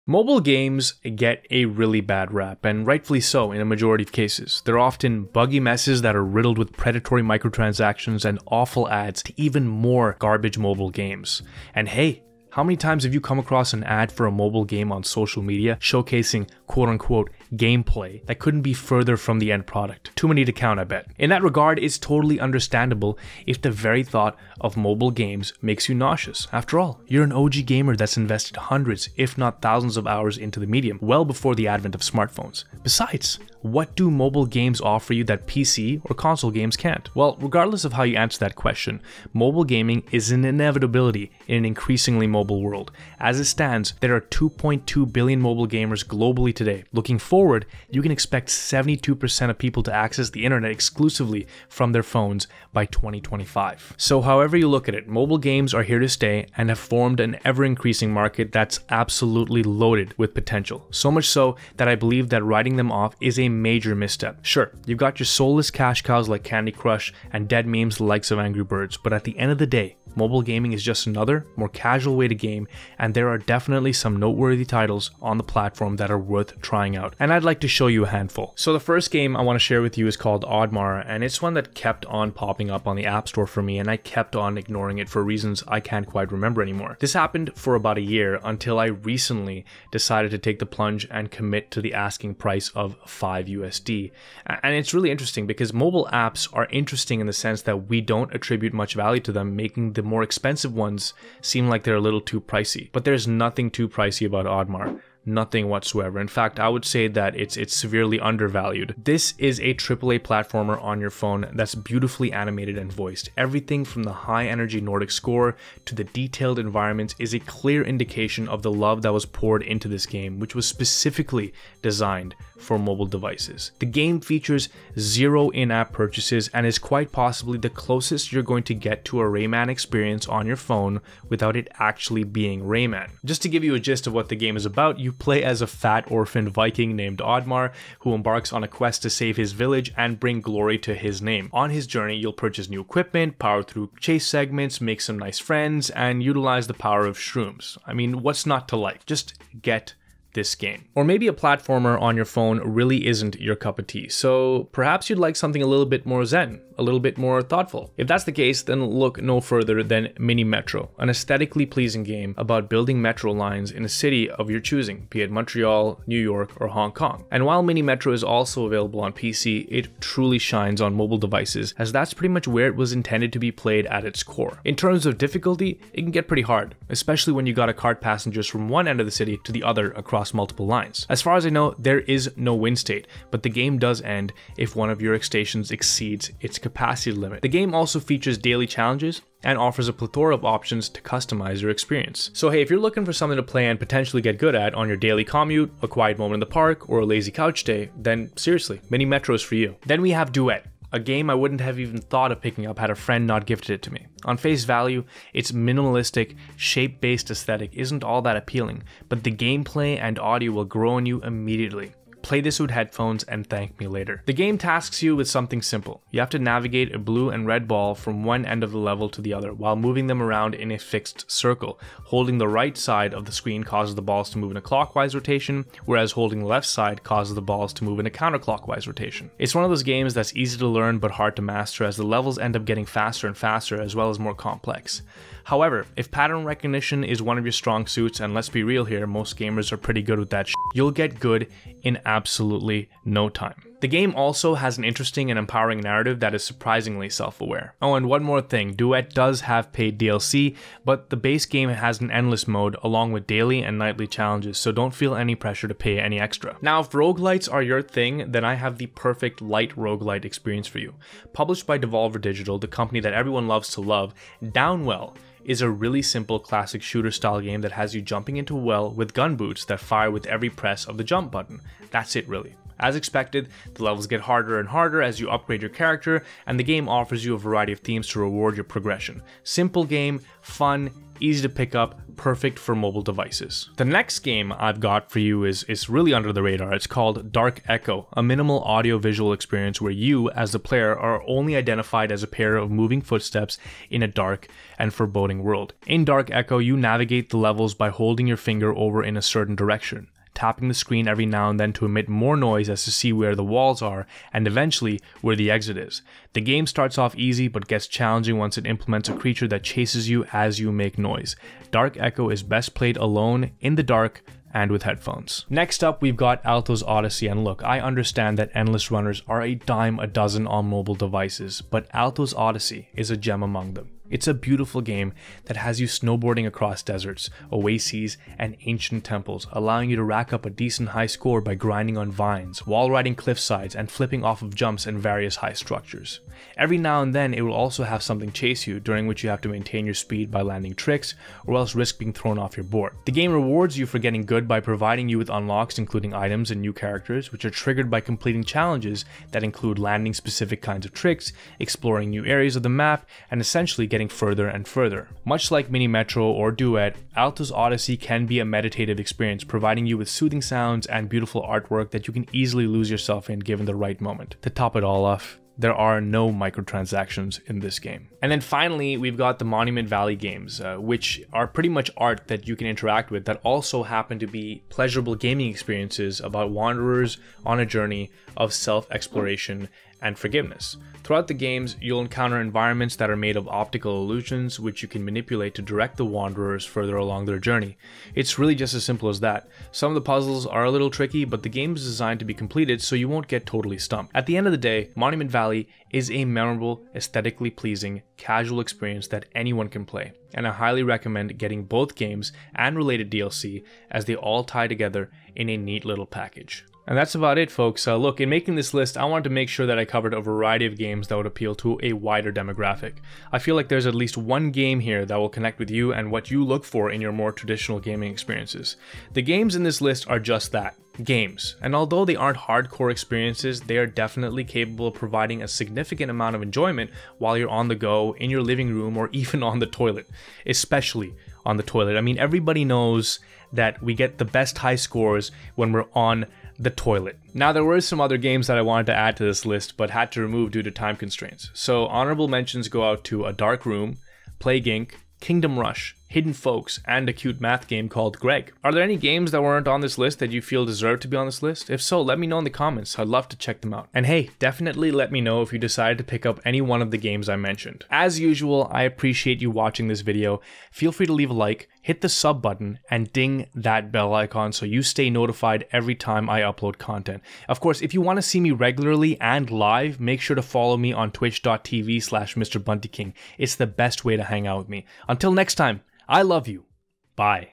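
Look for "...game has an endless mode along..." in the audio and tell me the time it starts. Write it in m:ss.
4:11.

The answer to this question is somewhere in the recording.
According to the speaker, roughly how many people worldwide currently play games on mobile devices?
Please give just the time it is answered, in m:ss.
0:44.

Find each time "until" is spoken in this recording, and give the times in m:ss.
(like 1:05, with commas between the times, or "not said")
1:28, 7:55.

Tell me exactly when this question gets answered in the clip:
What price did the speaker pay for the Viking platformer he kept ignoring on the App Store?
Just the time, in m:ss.
1:33.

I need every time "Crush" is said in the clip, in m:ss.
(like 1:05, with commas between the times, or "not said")
1:06.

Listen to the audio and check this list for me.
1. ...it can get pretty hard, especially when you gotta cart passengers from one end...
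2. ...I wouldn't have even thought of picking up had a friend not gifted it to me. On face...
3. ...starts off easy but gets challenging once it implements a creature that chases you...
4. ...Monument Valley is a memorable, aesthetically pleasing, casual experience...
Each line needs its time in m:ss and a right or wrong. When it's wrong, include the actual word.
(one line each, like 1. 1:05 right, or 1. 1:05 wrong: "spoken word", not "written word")
1. 2:55 right
2. 3:21 right
3. 5:06 right
4. 6:34 right.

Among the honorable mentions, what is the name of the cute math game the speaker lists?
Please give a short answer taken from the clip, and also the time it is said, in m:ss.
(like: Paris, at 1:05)
Greg, at 7:28.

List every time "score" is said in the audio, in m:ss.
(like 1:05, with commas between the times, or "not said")
1:55, 5:31, 7:14.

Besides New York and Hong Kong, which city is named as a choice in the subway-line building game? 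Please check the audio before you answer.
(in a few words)
Montreal.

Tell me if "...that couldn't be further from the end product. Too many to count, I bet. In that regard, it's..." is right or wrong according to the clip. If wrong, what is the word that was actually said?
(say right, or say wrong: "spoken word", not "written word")
right.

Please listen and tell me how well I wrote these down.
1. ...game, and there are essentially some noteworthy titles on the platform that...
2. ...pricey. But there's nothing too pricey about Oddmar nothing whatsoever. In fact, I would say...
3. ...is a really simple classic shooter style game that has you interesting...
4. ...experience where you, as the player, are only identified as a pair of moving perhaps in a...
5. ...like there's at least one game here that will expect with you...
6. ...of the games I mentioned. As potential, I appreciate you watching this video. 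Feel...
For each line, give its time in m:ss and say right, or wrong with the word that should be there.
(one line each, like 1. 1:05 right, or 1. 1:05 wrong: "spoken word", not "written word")
1. 1:12 wrong: "definitely", not "essentially"
2. 1:42 right
3. 4:25 wrong: "jumping", not "interesting"
4. 4:49 wrong: "footsteps", not "perhaps"
5. 6:53 wrong: "connect", not "expect"
6. 7:36 wrong: "usual", not "potential".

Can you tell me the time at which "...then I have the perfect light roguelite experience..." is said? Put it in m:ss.
4:18.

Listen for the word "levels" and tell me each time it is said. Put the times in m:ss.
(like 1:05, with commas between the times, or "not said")
3:38, 3:52, 4:33, 4:57.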